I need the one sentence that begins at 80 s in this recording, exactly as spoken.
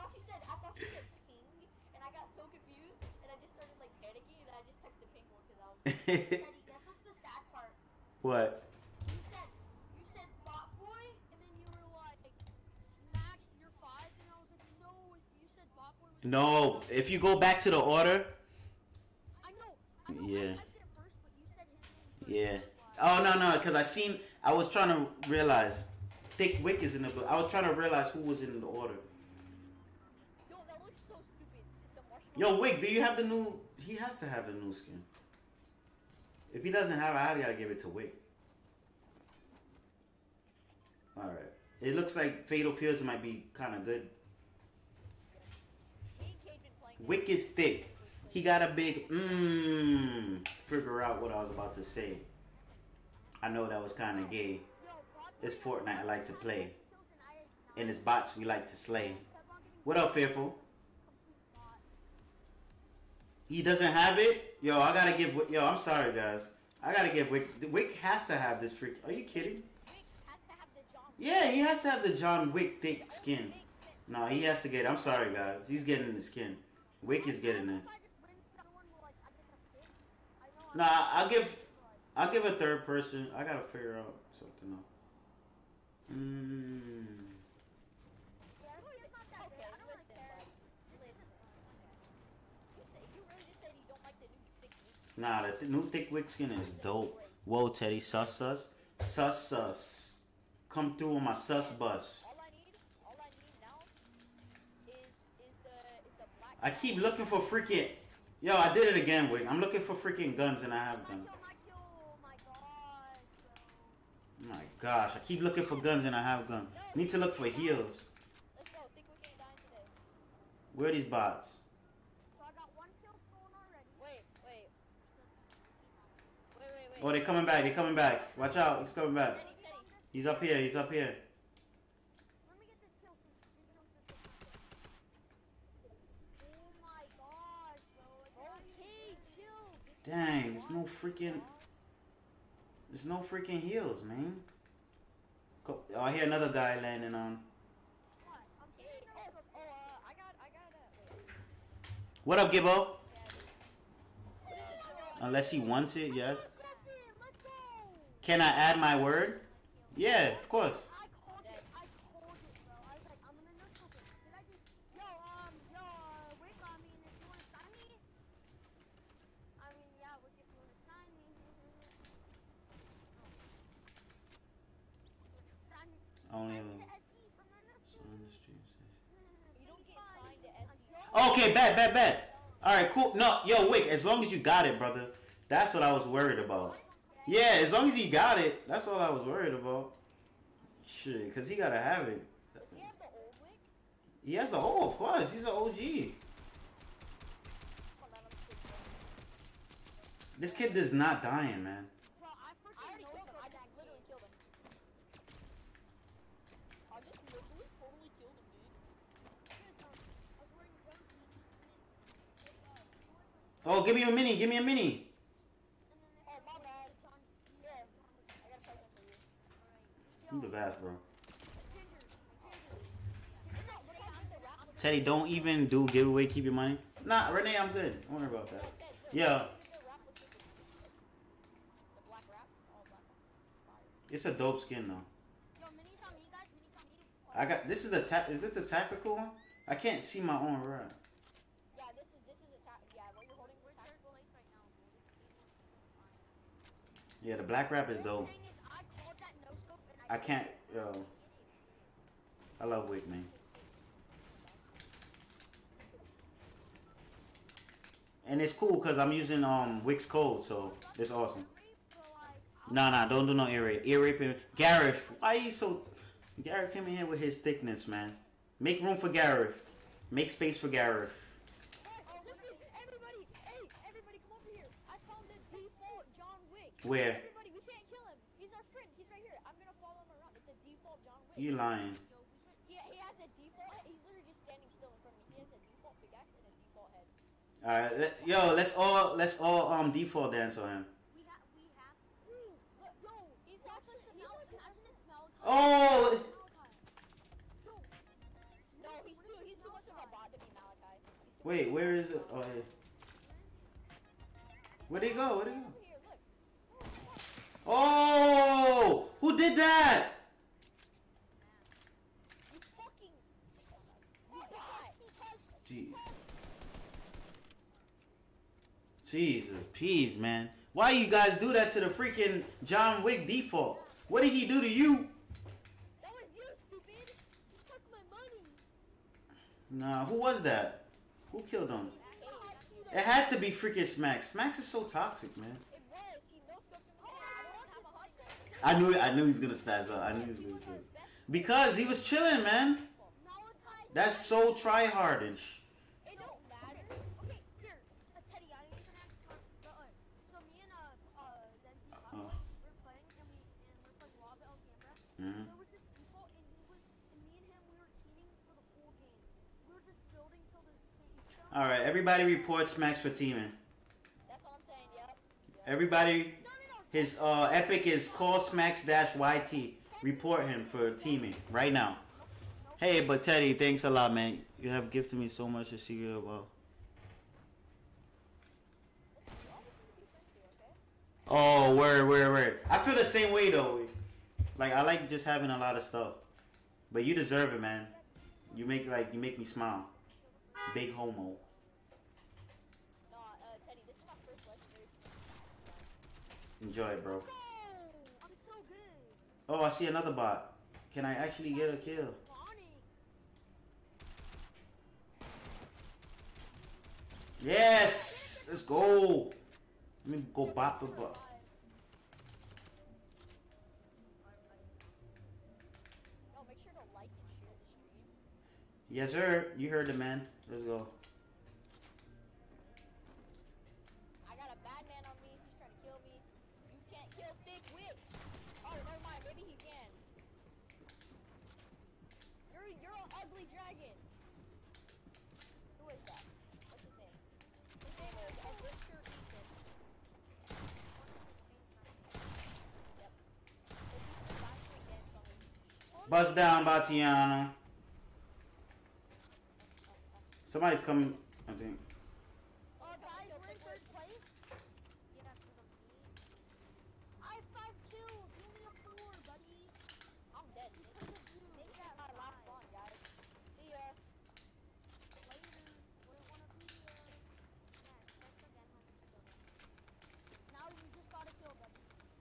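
Nah, I'll give I'll give a third person.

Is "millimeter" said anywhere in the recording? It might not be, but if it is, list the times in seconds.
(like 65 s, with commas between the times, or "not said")
not said.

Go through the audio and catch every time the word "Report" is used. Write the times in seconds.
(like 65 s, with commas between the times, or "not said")
370 s.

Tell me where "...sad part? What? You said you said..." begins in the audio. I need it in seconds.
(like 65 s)
7 s.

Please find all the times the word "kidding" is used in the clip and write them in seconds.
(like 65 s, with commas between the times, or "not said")
69 s.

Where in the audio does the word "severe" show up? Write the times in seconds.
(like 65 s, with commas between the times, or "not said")
not said.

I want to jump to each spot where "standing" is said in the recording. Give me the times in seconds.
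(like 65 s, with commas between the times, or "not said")
284 s.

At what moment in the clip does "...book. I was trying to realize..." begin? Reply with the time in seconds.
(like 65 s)
27 s.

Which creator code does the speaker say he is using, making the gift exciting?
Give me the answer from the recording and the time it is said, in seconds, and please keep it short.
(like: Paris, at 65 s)
Wick's code, at 259 s.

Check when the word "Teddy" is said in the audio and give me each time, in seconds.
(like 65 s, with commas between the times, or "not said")
97 s, 224 s, 373 s.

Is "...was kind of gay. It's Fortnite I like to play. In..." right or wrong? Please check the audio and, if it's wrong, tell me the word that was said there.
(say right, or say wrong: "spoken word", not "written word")
right.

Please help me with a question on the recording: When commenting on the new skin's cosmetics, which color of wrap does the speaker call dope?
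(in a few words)
black.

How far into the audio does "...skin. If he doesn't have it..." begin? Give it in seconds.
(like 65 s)
34 s.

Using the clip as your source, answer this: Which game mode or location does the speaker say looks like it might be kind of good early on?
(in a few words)
Fatal Fields.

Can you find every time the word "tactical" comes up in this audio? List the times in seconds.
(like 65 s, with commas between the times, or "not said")
238 s.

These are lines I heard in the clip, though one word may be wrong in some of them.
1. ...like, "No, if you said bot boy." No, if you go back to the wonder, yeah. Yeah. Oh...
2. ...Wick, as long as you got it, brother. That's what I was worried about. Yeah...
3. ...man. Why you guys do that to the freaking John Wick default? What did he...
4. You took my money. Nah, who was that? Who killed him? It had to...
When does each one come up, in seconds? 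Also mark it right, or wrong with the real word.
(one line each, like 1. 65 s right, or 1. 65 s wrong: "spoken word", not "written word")
1. 14 s wrong: "order", not "wonder"
2. 183 s right
3. 320 s right
4. 327 s right.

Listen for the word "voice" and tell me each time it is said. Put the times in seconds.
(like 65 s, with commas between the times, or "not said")
not said.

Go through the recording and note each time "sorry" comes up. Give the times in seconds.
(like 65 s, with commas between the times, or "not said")
65 s, 74 s.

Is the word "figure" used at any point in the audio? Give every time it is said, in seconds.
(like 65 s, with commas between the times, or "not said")
50 s, 83 s.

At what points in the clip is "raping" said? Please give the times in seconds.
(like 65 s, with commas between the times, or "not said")
264 s.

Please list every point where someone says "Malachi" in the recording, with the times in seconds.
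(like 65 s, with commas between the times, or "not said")
295 s, 300 s.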